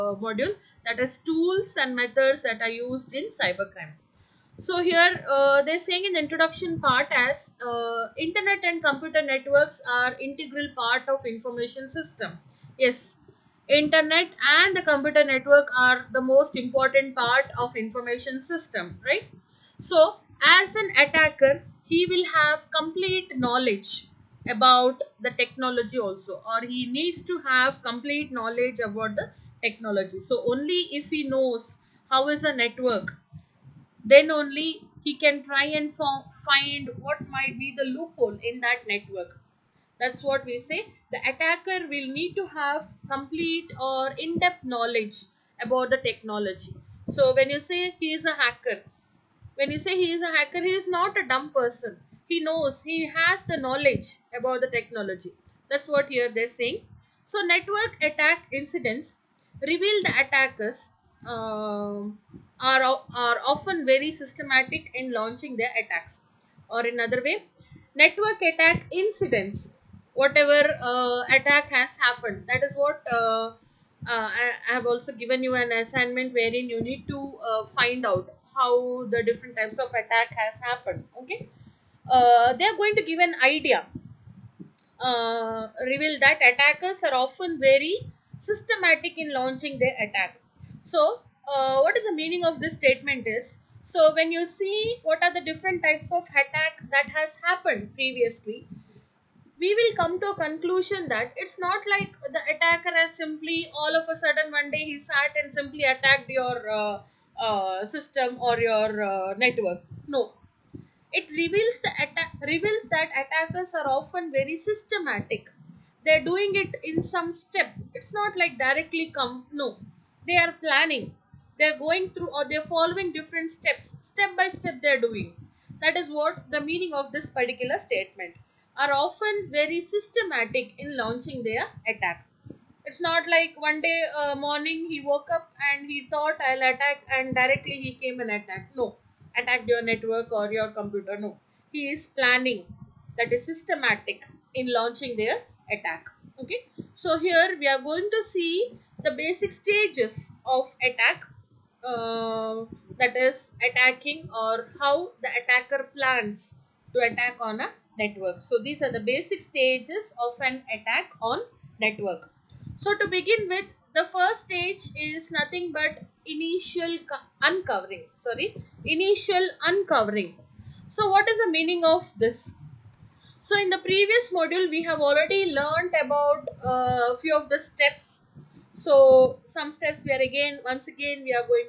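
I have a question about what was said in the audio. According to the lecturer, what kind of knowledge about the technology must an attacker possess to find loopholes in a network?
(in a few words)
Complete or in-depth knowledge.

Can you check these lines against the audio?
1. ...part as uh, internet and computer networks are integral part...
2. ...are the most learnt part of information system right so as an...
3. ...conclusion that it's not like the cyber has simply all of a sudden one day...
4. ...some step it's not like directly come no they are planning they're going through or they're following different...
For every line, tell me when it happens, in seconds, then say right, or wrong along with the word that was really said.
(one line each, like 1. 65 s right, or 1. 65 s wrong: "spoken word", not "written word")
1. 6 s right
2. 15 s wrong: "important", not "learnt"
3. 100 s wrong: "attacker", not "cyber"
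4. 117 s right.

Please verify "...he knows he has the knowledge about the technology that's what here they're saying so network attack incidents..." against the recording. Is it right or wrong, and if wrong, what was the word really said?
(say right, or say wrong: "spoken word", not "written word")
right.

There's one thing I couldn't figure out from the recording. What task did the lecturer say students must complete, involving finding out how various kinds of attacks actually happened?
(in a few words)
An assignment.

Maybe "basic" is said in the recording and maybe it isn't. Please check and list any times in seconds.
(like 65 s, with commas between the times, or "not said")
149 s, 158 s.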